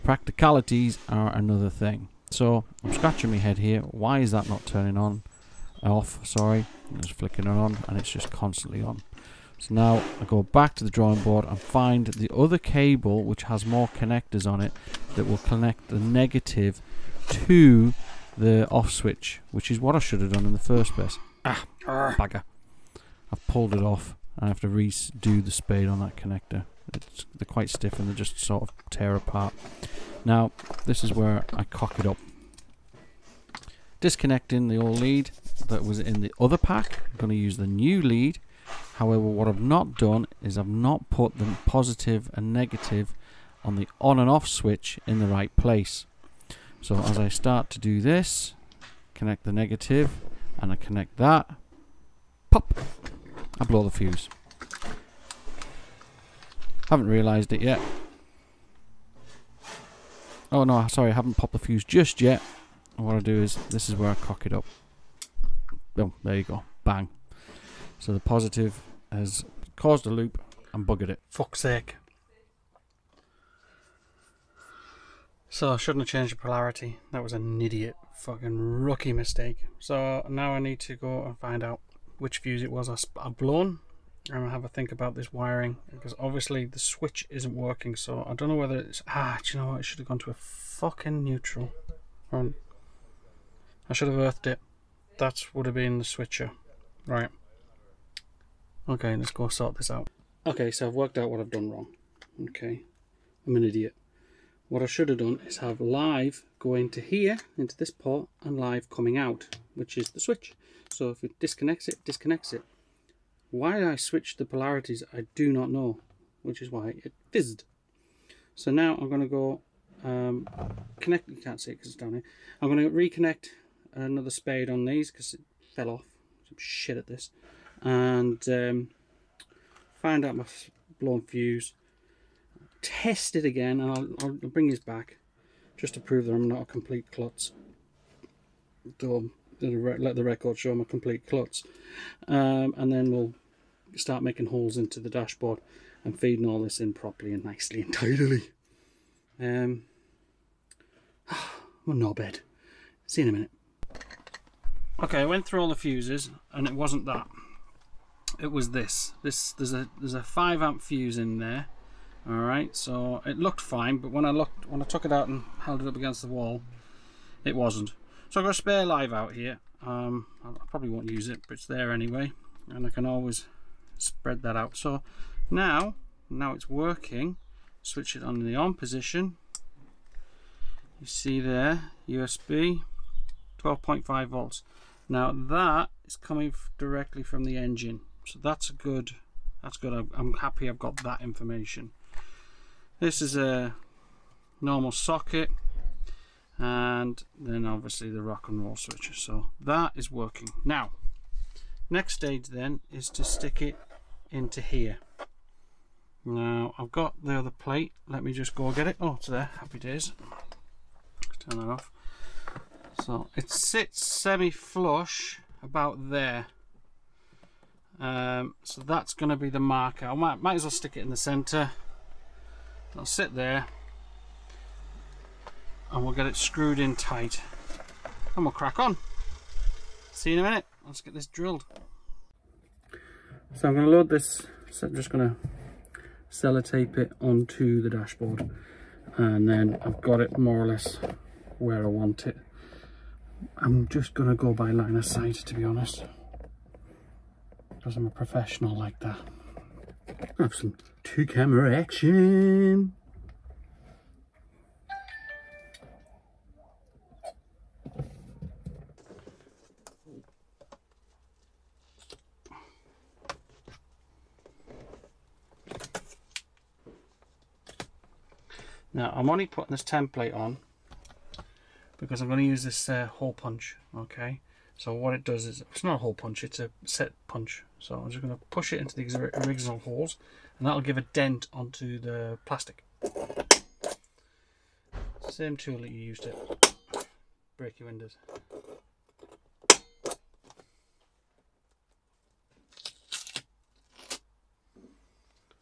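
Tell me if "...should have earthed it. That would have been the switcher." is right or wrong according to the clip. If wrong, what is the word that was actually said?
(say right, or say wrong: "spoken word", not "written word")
right.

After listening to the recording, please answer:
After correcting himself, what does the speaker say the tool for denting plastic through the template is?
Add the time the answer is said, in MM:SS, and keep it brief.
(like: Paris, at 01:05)
A set punch, at 04:36.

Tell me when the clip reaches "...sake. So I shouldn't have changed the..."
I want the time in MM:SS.
01:11.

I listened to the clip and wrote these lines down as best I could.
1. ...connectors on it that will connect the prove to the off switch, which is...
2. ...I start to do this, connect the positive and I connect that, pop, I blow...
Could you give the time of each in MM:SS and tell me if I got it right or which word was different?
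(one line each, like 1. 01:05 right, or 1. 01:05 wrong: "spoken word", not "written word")
1. 00:13 wrong: "negative", not "prove"
2. 00:47 wrong: "negative", not "positive".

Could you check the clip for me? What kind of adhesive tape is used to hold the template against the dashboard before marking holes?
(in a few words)
Sellotape.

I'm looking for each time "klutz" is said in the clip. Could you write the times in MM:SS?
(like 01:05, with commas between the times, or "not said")
02:17, 02:21.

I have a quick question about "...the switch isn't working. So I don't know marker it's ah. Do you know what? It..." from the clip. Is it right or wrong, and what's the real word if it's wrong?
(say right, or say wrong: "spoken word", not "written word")
wrong: "whether", not "marker".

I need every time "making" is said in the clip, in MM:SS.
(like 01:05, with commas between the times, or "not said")
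02:24.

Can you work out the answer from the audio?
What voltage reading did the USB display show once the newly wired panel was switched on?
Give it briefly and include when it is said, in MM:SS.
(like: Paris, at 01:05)
12.5 volts, at 03:03.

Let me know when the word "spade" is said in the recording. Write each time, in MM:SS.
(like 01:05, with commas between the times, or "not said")
00:25, 02:04.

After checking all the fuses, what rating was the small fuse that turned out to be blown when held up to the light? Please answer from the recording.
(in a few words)
5 amp.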